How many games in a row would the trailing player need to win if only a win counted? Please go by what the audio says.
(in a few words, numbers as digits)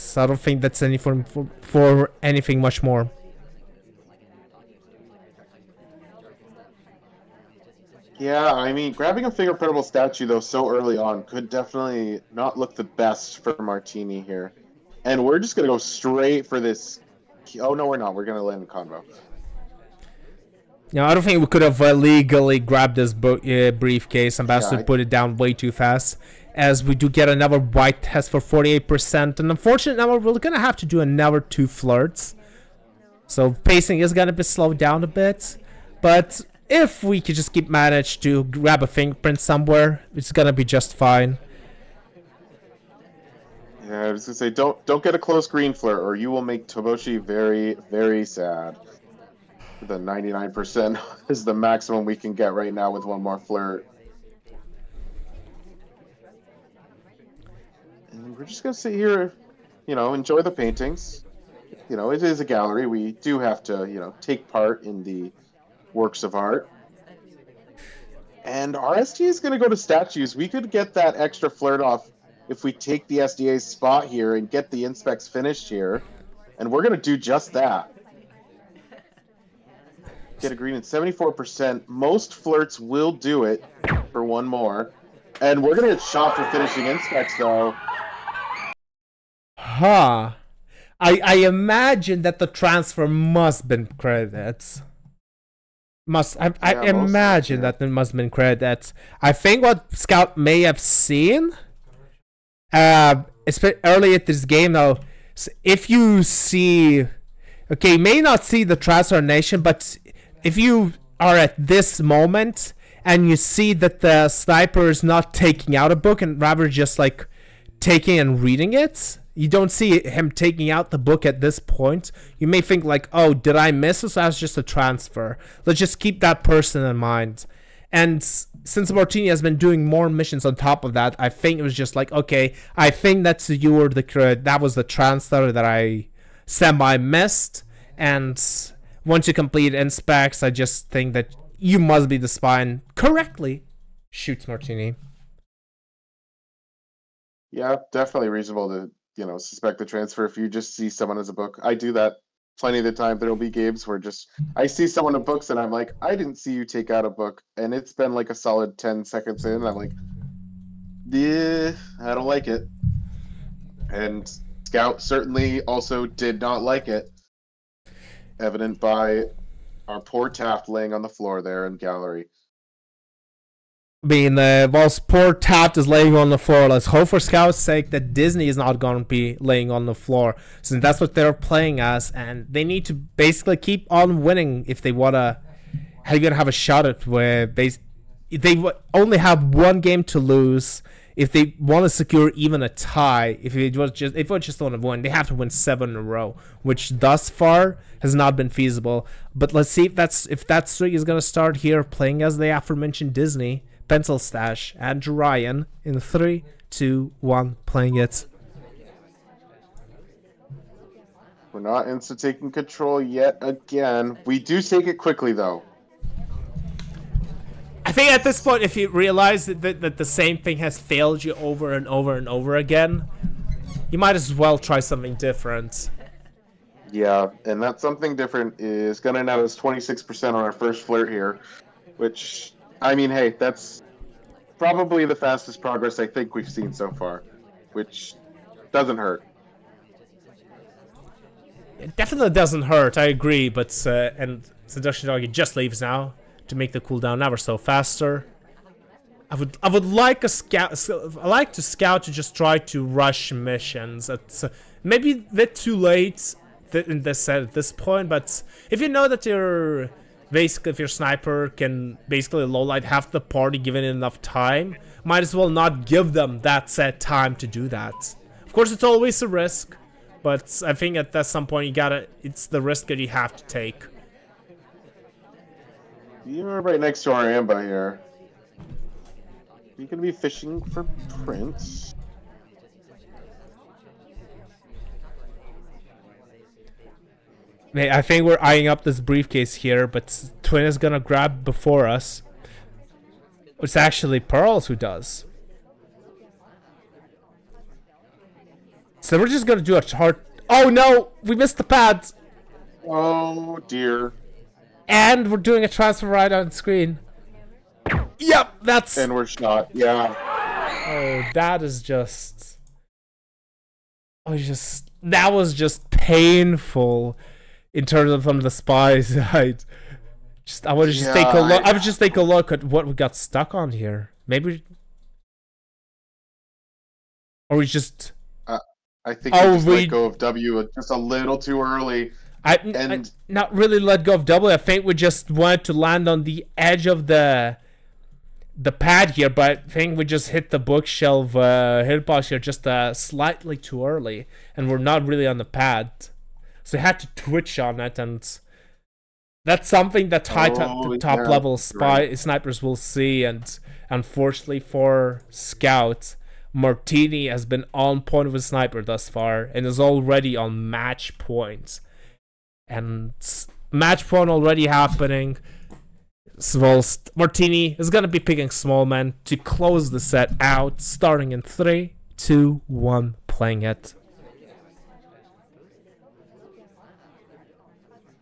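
7.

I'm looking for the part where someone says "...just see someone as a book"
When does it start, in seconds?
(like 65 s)
150 s.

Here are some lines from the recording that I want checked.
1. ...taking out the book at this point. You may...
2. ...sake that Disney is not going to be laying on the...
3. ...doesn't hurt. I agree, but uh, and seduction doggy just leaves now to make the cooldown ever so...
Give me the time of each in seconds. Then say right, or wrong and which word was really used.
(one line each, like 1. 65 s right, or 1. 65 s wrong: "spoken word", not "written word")
1. 120 s right
2. 177 s right
3. 242 s right.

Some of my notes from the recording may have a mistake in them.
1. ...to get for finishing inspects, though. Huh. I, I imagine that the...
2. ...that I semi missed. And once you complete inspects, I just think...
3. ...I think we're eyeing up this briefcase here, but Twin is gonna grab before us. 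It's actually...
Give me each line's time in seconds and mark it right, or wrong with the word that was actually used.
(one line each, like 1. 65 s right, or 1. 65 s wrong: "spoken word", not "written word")
1. 85 s right
2. 135 s right
3. 287 s right.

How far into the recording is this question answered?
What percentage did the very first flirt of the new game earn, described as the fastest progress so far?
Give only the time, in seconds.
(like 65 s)
229 s.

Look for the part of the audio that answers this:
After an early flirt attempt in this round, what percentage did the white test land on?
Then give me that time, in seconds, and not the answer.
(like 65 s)
28 s.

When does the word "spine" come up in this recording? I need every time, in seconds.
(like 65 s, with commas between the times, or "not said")
142 s.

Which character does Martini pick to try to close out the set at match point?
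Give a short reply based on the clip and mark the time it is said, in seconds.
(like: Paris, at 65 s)
Smallman, at 368 s.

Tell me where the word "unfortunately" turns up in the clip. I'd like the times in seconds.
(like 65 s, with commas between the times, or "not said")
29 s, 353 s.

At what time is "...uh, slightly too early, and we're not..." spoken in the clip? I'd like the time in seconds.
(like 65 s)
342 s.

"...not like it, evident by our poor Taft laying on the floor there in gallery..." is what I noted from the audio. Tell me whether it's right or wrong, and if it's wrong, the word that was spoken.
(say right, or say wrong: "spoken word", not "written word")
right.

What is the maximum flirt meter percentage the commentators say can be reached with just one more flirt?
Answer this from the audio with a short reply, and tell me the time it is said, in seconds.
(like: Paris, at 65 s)
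99%, at 49 s.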